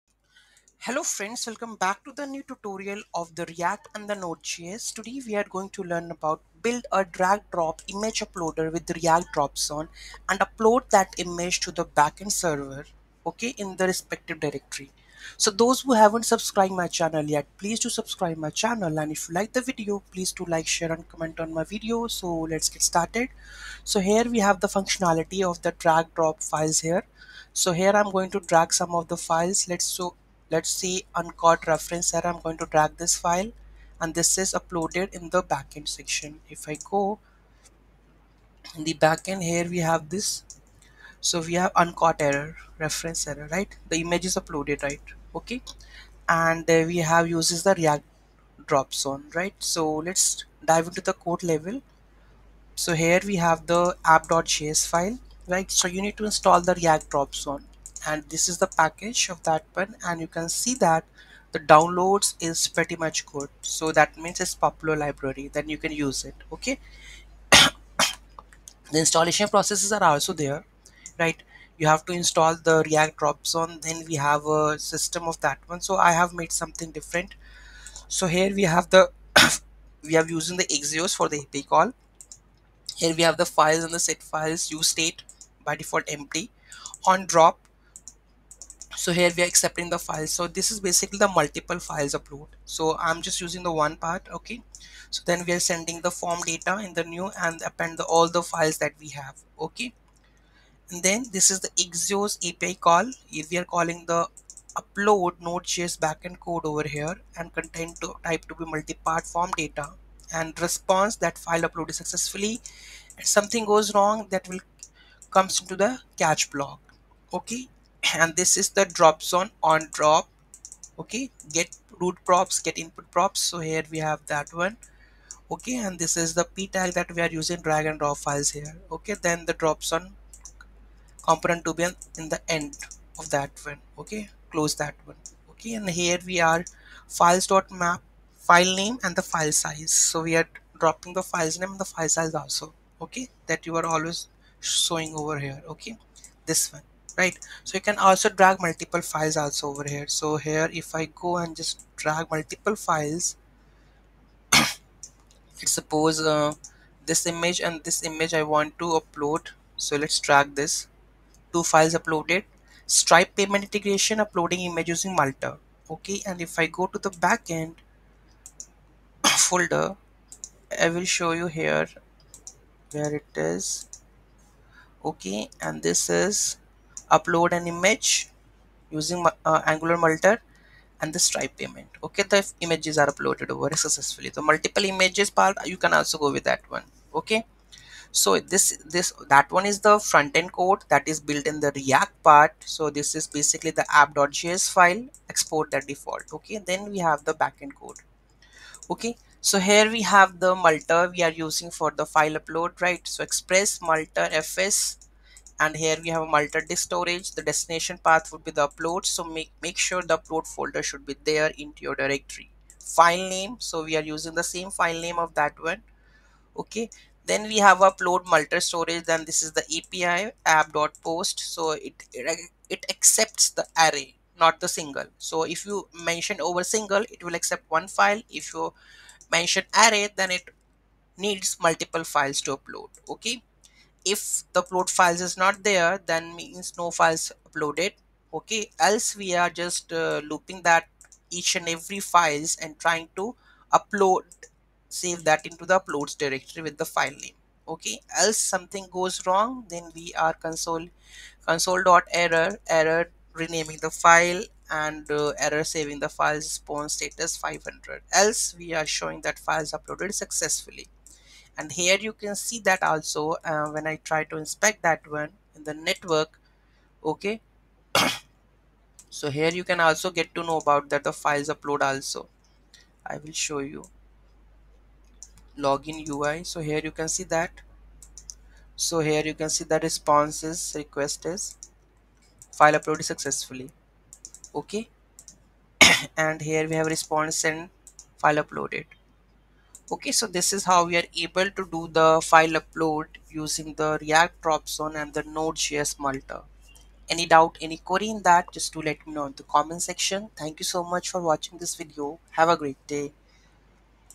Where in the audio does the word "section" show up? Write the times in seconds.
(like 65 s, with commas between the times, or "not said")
35 s, 299 s.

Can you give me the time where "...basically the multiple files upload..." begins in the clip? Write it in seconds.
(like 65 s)
90 s.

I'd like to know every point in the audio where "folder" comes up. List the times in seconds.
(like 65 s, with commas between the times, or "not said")
169 s, 210 s.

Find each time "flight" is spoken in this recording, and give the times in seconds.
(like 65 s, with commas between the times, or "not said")
not said.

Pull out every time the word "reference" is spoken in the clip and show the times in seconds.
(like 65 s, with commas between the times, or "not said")
31 s, 42 s.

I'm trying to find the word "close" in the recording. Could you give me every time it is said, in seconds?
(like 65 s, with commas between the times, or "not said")
134 s.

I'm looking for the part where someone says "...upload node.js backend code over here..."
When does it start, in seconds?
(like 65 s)
104 s.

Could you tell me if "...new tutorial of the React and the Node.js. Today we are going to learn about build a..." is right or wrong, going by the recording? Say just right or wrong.
right.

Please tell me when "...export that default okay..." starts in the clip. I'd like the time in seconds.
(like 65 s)
195 s.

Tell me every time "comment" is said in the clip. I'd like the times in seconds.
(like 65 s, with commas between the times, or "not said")
21 s, 299 s.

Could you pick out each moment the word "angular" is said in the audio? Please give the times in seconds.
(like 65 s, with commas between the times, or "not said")
179 s.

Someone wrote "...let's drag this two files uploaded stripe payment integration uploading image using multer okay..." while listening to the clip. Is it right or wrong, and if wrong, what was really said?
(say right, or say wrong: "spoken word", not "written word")
right.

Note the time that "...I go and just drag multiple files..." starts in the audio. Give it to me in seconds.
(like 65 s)
150 s.